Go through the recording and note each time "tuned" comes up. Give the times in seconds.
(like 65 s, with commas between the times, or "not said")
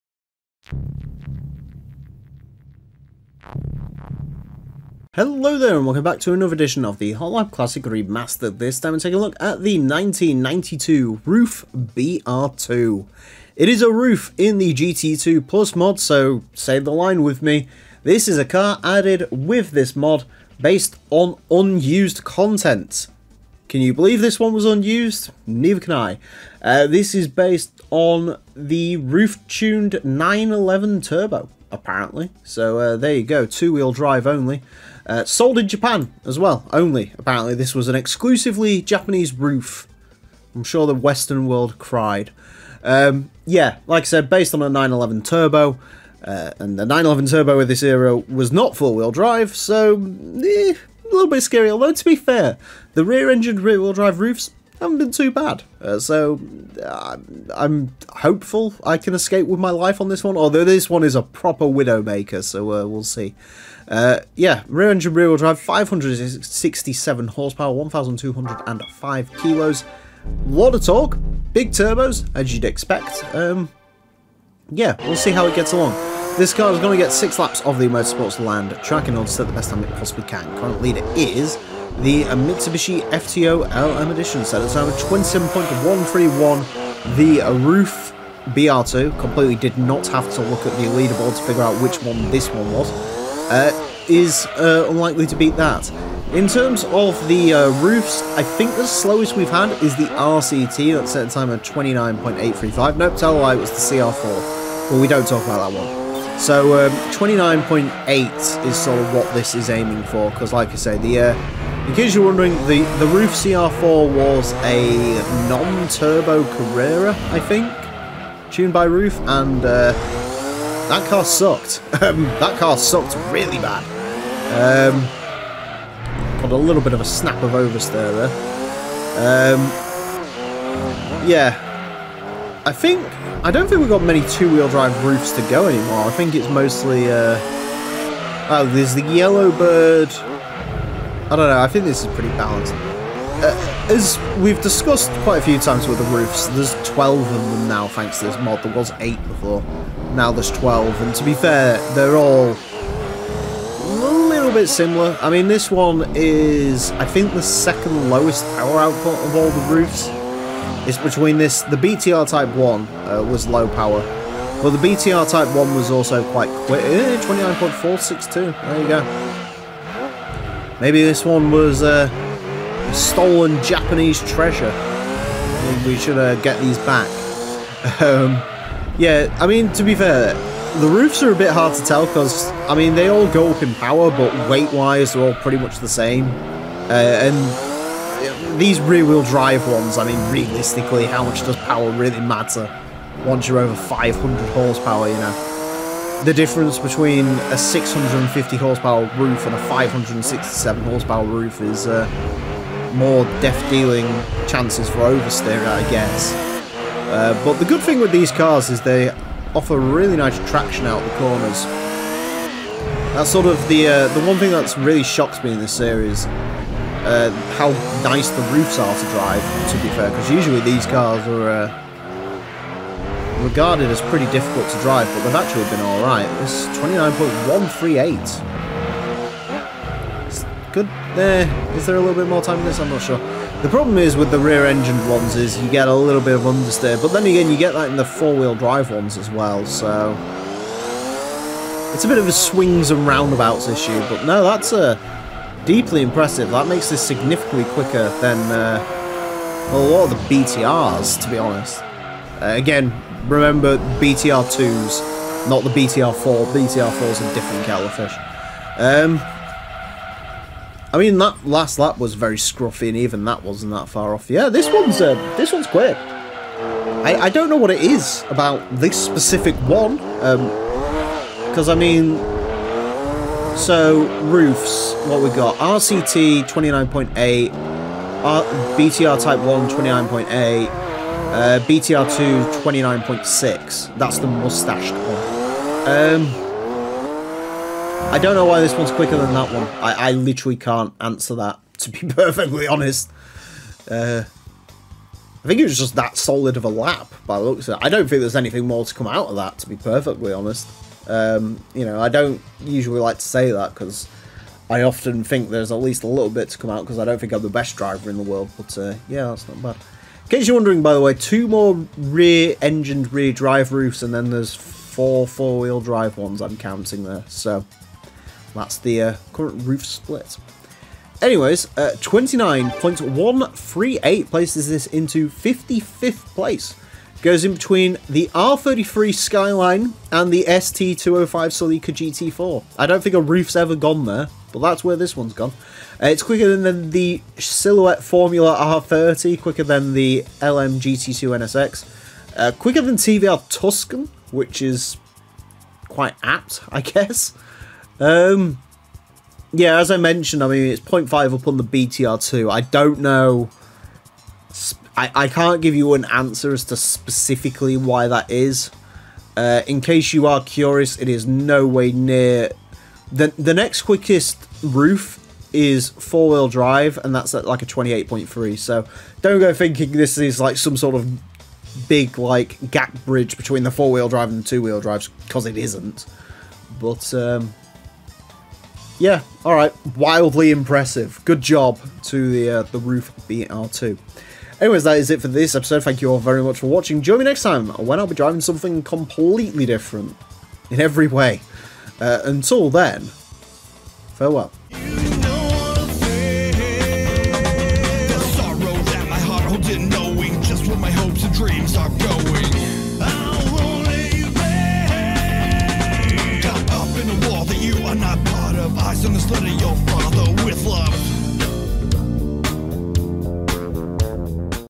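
28 s, 118 s.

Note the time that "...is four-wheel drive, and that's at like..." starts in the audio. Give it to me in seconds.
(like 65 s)
365 s.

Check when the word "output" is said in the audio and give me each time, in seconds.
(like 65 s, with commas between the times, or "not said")
158 s.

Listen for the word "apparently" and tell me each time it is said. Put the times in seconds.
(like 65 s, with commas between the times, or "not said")
31 s, 37 s.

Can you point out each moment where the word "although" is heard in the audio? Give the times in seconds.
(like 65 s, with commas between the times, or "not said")
51 s, 60 s.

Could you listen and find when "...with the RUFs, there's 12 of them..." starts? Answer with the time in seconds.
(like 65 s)
145 s.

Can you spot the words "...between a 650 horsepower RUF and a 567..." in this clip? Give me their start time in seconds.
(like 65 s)
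196 s.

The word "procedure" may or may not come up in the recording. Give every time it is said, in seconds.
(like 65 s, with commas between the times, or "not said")
not said.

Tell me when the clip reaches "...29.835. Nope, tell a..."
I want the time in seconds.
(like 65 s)
101 s.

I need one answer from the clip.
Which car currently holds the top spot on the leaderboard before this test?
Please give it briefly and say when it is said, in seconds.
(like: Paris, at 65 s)
Mitsubishi FTO LM Edition, at 82 s.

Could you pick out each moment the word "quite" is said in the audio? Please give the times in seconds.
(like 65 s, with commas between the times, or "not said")
145 s, 166 s, 345 s.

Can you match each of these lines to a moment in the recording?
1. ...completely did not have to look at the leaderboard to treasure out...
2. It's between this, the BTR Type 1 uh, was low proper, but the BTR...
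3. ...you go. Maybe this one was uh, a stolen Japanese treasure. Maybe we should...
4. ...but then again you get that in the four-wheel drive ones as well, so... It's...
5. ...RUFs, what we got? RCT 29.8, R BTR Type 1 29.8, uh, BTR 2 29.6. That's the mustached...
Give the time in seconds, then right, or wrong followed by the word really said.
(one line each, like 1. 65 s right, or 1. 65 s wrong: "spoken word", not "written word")
1. 89 s wrong: "figure", not "treasure"
2. 160 s wrong: "power", not "proper"
3. 168 s right
4. 237 s right
5. 274 s right.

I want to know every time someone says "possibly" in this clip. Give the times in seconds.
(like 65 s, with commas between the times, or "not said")
79 s.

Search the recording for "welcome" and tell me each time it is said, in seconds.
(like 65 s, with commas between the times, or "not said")
5 s.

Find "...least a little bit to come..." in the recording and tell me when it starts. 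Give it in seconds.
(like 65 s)
305 s.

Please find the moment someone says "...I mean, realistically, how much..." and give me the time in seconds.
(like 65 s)
189 s.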